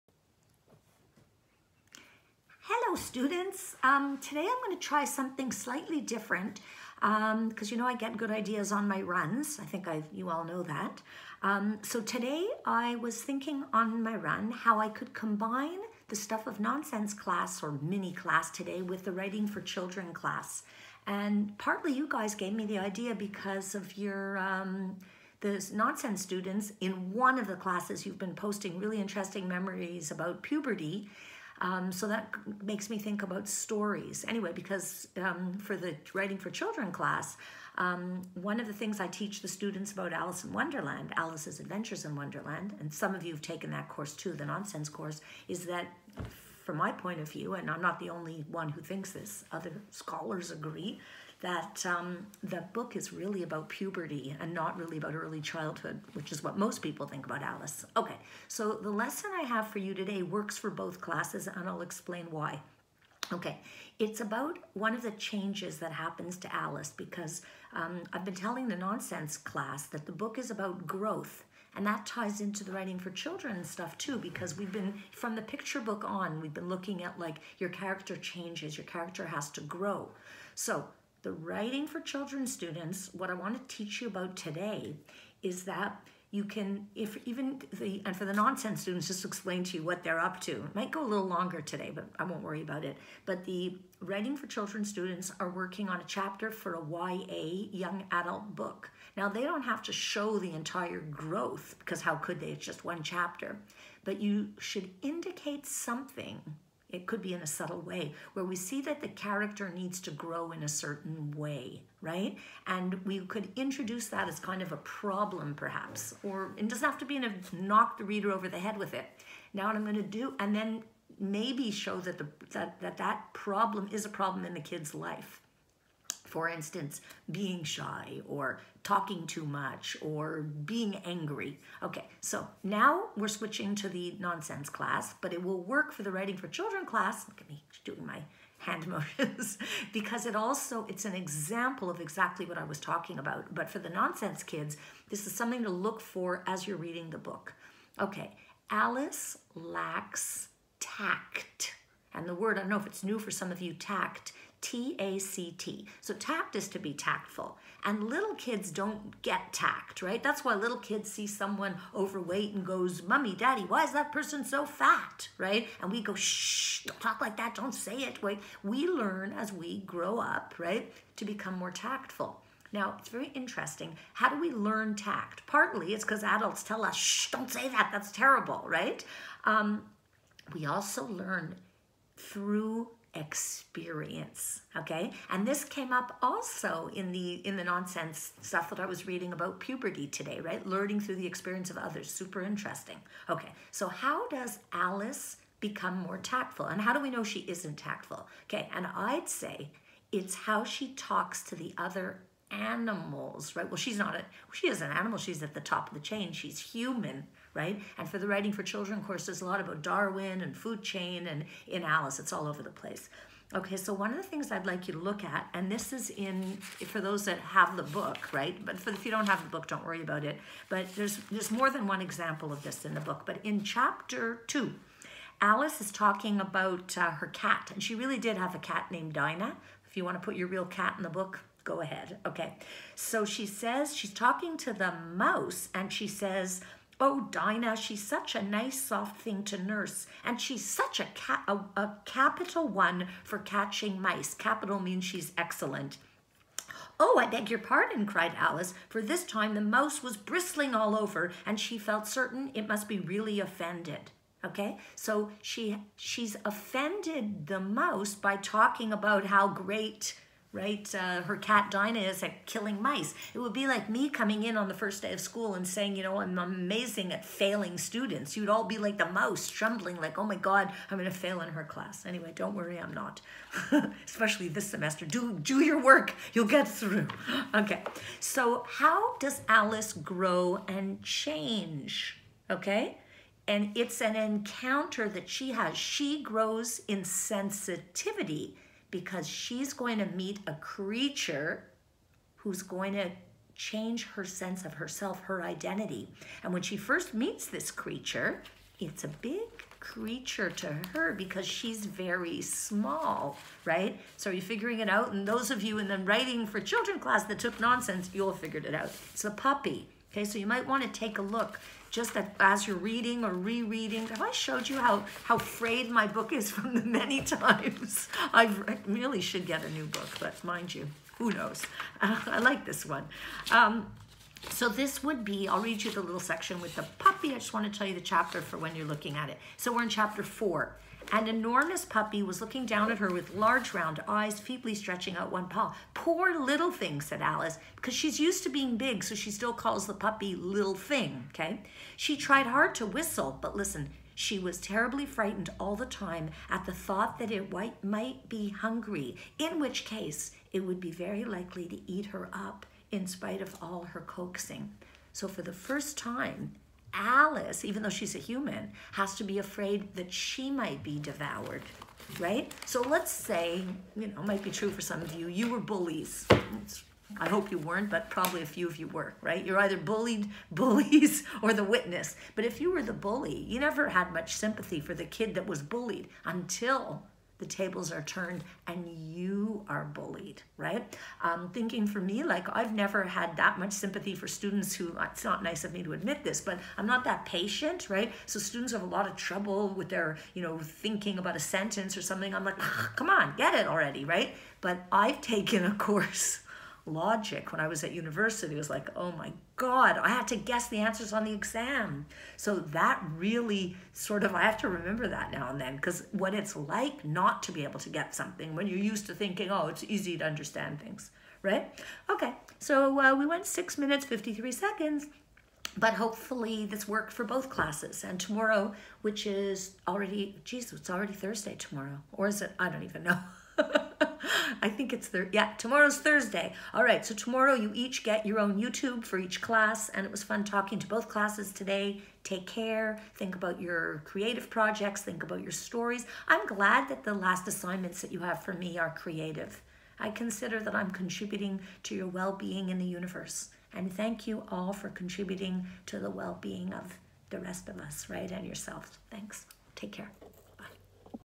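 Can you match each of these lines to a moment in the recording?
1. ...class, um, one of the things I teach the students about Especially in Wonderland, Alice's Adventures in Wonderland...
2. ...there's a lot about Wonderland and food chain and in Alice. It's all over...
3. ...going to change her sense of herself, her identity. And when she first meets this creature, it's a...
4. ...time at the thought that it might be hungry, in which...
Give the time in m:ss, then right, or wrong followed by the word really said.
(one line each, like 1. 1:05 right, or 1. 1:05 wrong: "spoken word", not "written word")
1. 0:36 wrong: "Alice", not "Especially"
2. 3:29 wrong: "Darwin", not "Wonderland"
3. 4:52 right
4. 5:45 right.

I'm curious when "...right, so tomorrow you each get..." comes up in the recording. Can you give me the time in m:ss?
7:06.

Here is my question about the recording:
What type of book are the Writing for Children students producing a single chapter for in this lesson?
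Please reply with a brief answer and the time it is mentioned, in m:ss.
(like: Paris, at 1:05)
YA, at 1:37.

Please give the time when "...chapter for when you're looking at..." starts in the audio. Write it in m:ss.
5:28.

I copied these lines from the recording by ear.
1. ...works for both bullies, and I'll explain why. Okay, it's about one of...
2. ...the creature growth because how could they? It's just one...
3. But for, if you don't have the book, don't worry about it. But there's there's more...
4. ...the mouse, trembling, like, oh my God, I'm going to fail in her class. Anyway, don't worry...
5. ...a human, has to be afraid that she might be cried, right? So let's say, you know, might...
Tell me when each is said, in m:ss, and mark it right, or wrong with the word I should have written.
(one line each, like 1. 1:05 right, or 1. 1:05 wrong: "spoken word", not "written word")
1. 1:00 wrong: "classes", not "bullies"
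2. 1:40 wrong: "entire", not "creature"
3. 3:38 right
4. 4:28 right
5. 5:58 wrong: "devoured", not "cried".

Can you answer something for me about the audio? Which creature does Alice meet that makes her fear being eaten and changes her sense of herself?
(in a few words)
A puppy.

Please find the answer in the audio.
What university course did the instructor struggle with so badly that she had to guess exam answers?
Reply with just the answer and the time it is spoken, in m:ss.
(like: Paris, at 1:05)
Logic, at 6:36.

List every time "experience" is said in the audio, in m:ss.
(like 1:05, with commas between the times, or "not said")
3:03, 3:11.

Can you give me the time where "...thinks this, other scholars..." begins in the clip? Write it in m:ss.
0:48.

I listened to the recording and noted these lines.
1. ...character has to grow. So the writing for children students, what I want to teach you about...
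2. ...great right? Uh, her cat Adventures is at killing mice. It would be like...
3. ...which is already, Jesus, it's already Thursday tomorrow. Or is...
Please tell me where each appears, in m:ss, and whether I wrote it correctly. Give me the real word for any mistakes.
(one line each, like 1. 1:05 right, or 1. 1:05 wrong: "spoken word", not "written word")
1. 1:18 right
2. 4:19 wrong: "Dinah", not "Adventures"
3. 6:59 right.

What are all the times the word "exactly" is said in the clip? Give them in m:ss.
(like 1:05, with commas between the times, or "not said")
2:21.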